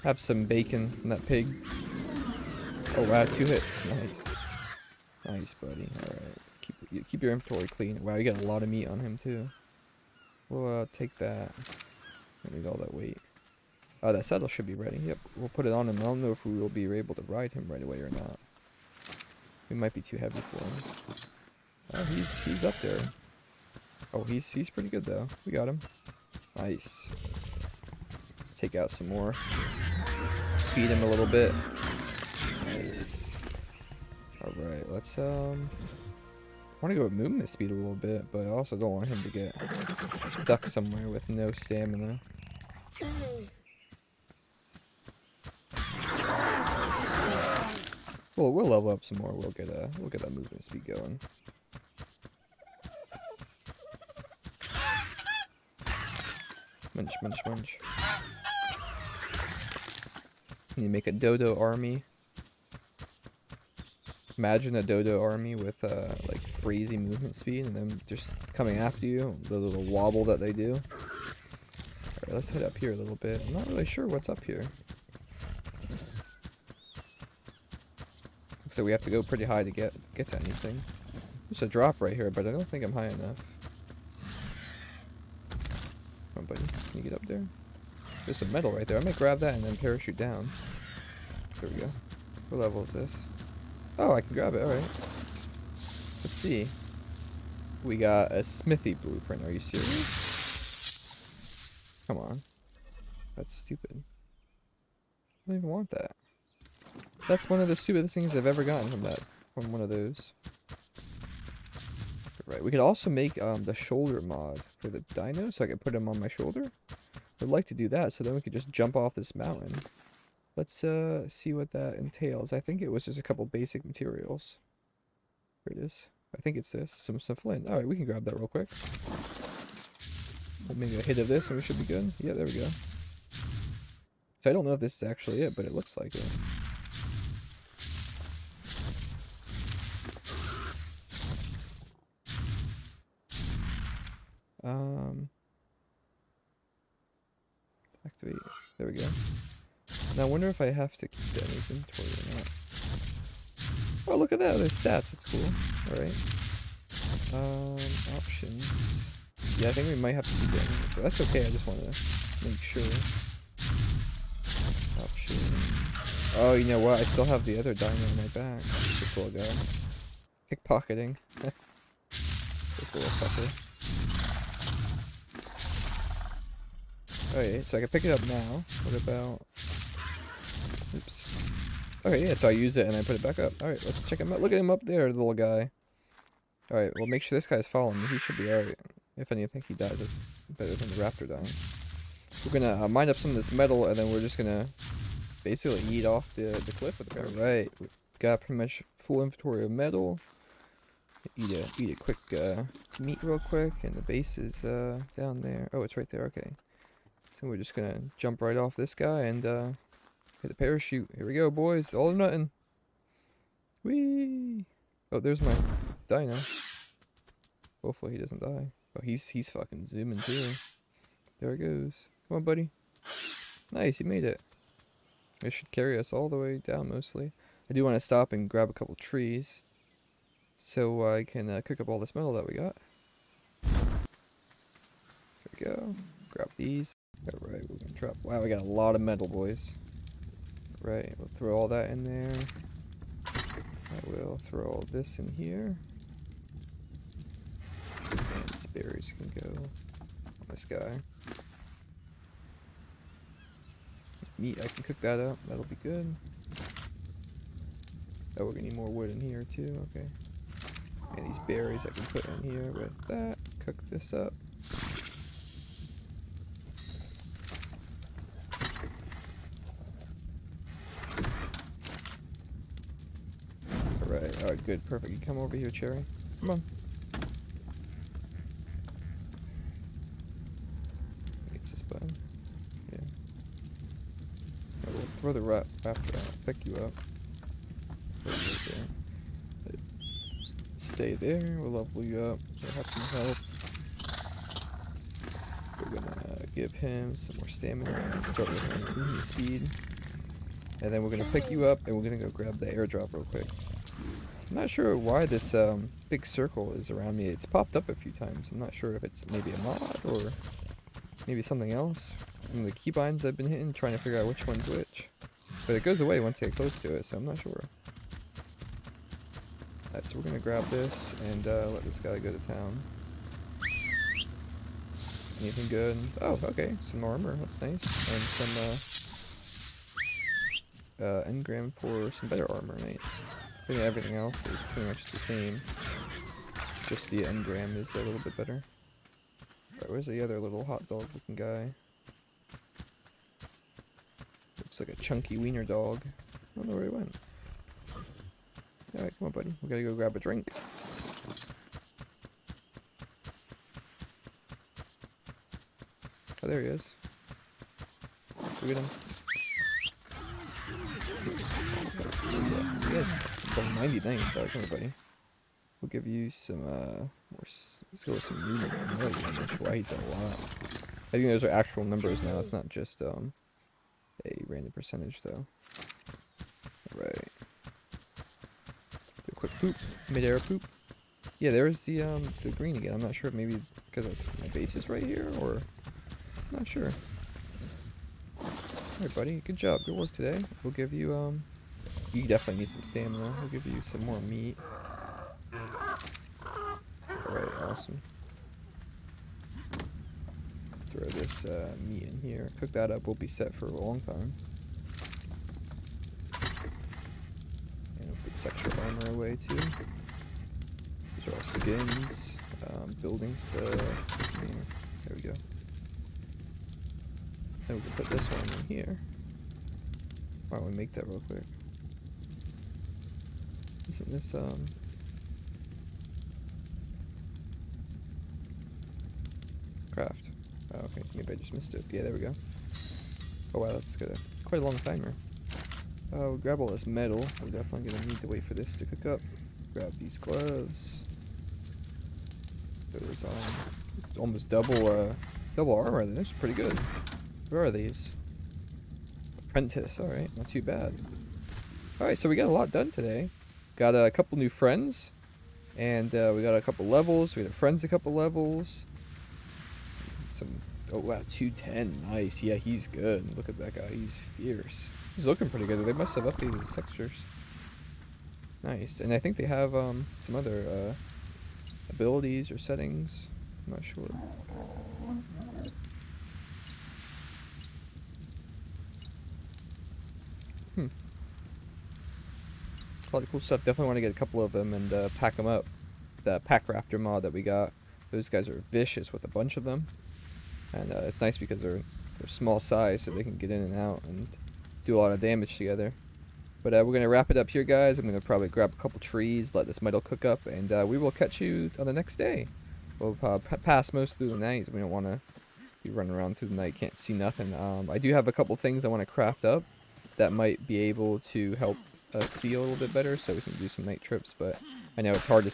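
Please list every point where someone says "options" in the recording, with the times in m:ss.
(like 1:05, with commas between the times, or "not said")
2:38, 2:45.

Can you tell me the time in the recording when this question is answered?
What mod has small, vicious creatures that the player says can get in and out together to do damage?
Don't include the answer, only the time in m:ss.
8:06.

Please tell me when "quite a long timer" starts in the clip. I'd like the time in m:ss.
7:14.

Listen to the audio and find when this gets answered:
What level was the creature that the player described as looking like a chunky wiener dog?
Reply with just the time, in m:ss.
6:03.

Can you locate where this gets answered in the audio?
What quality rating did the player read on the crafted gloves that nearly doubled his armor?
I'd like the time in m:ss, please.
7:29.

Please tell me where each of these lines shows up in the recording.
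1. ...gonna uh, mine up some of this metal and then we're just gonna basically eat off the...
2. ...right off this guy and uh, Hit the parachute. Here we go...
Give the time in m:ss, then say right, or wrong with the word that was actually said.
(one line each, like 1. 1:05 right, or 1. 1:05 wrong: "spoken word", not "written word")
1. 3:12 right
2. 3:28 right.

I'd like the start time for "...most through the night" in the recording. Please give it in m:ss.
8:23.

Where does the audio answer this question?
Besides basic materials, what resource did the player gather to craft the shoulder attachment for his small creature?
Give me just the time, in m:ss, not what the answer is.
2:07.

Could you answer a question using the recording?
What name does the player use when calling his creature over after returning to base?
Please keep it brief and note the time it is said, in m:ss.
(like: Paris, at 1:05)
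Cherry, at 4:35.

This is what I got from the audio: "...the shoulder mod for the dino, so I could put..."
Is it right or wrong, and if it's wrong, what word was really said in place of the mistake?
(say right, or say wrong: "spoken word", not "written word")
right.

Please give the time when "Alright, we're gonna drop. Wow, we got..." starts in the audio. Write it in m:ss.
3:57.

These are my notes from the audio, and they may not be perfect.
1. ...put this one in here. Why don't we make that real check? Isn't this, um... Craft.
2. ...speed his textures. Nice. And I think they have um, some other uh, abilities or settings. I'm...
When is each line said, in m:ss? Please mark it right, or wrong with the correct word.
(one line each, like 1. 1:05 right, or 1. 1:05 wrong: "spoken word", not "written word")
1. 6:57 wrong: "quick", not "check"
2. 7:46 wrong: "updated", not "speed".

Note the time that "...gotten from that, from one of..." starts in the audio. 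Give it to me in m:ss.
1:48.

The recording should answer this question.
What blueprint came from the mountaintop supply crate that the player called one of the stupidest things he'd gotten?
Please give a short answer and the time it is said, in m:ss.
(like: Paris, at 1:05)
Smithy, at 1:38.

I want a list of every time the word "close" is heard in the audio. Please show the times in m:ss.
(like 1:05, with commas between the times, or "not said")
5:16.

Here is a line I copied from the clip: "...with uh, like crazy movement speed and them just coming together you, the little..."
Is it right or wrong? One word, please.
wrong.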